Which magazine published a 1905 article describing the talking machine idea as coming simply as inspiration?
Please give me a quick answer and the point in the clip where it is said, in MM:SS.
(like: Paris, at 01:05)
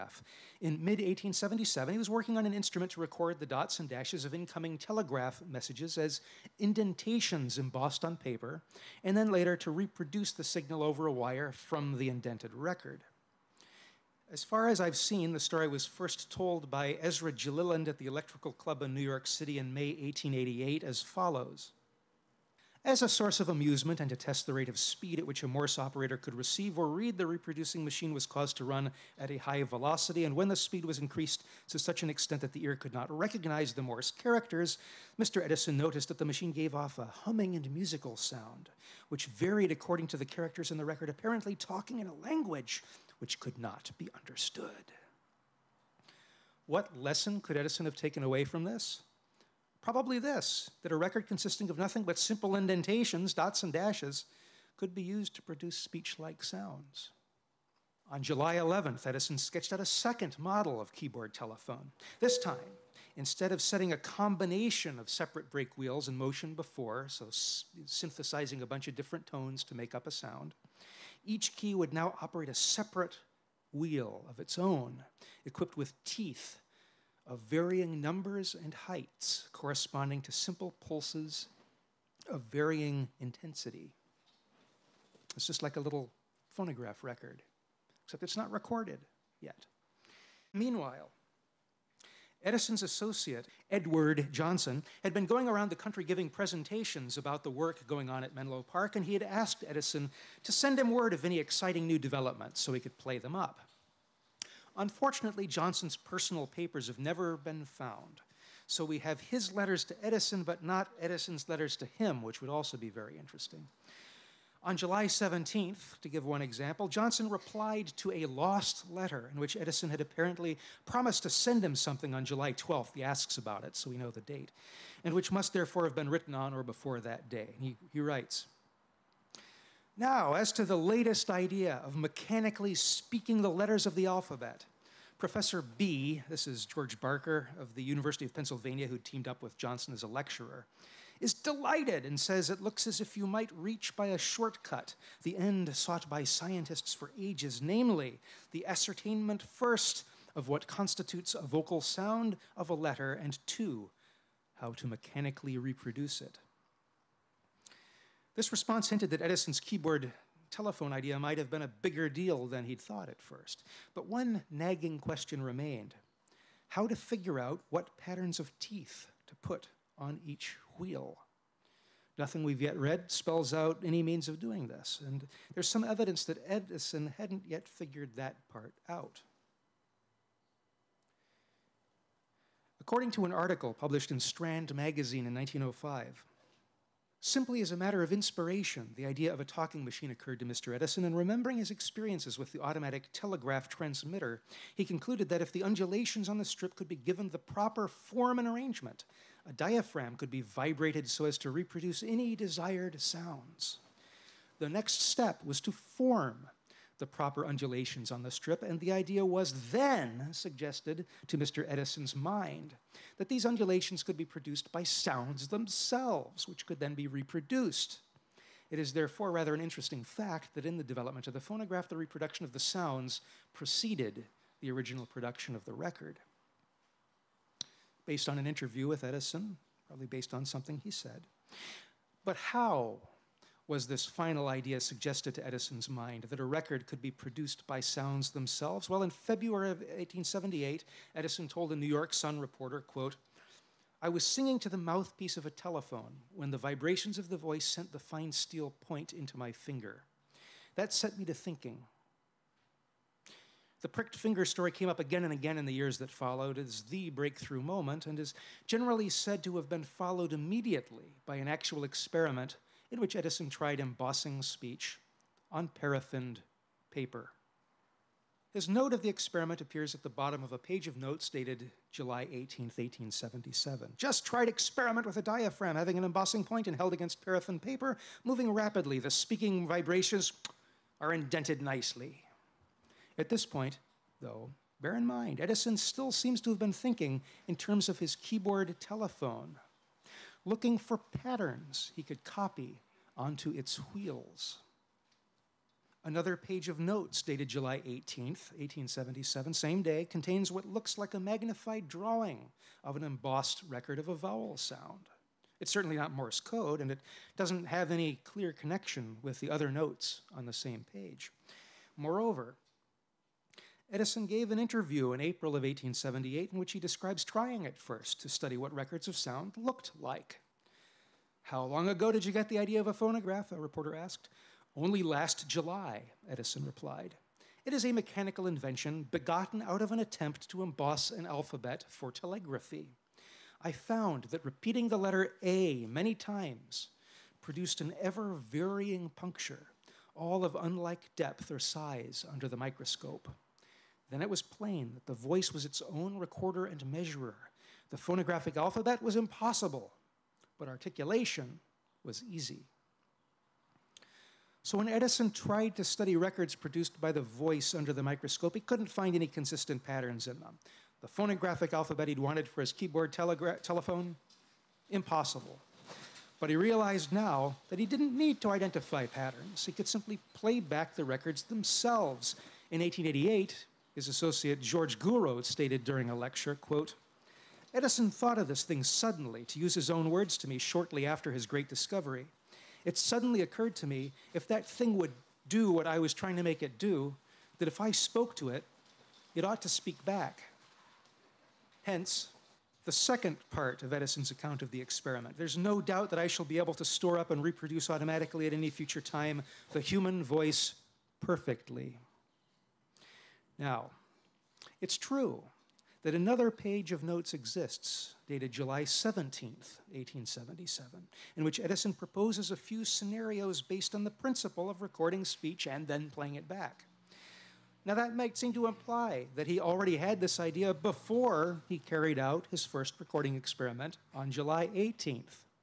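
Strand magazine, at 03:04.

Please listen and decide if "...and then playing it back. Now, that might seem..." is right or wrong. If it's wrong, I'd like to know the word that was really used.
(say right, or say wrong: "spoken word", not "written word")
right.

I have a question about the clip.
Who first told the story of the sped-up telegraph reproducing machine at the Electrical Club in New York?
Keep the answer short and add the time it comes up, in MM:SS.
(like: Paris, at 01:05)
Ezra Gilliland, at 00:17.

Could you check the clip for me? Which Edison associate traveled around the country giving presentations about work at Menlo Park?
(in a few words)
Edward Johnson.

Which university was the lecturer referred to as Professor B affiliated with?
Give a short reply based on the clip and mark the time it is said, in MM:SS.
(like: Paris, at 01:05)
University of Pennsylvania, at 02:17.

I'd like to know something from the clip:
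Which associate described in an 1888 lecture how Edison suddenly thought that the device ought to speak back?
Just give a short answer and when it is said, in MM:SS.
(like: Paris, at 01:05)
George Gouraud, at 06:14.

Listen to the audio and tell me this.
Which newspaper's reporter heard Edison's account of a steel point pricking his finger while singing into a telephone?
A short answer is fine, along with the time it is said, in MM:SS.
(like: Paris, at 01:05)
New York Sun, at 04:01.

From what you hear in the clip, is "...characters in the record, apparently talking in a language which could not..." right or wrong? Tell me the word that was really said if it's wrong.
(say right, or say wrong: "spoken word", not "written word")
right.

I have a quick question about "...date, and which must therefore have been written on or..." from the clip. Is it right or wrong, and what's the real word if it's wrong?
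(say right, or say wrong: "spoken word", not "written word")
right.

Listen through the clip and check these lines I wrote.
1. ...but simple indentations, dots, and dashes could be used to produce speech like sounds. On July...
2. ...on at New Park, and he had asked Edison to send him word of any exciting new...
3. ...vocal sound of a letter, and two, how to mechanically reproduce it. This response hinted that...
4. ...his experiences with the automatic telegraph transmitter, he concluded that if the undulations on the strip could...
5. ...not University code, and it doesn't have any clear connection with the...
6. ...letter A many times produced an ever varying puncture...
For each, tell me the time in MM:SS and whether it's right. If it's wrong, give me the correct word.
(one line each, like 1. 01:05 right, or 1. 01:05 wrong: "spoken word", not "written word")
1. 00:52 right
2. 01:38 wrong: "Menlo", not "New"
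3. 02:31 right
4. 03:11 right
5. 05:05 wrong: "Morse", not "University"
6. 05:34 right.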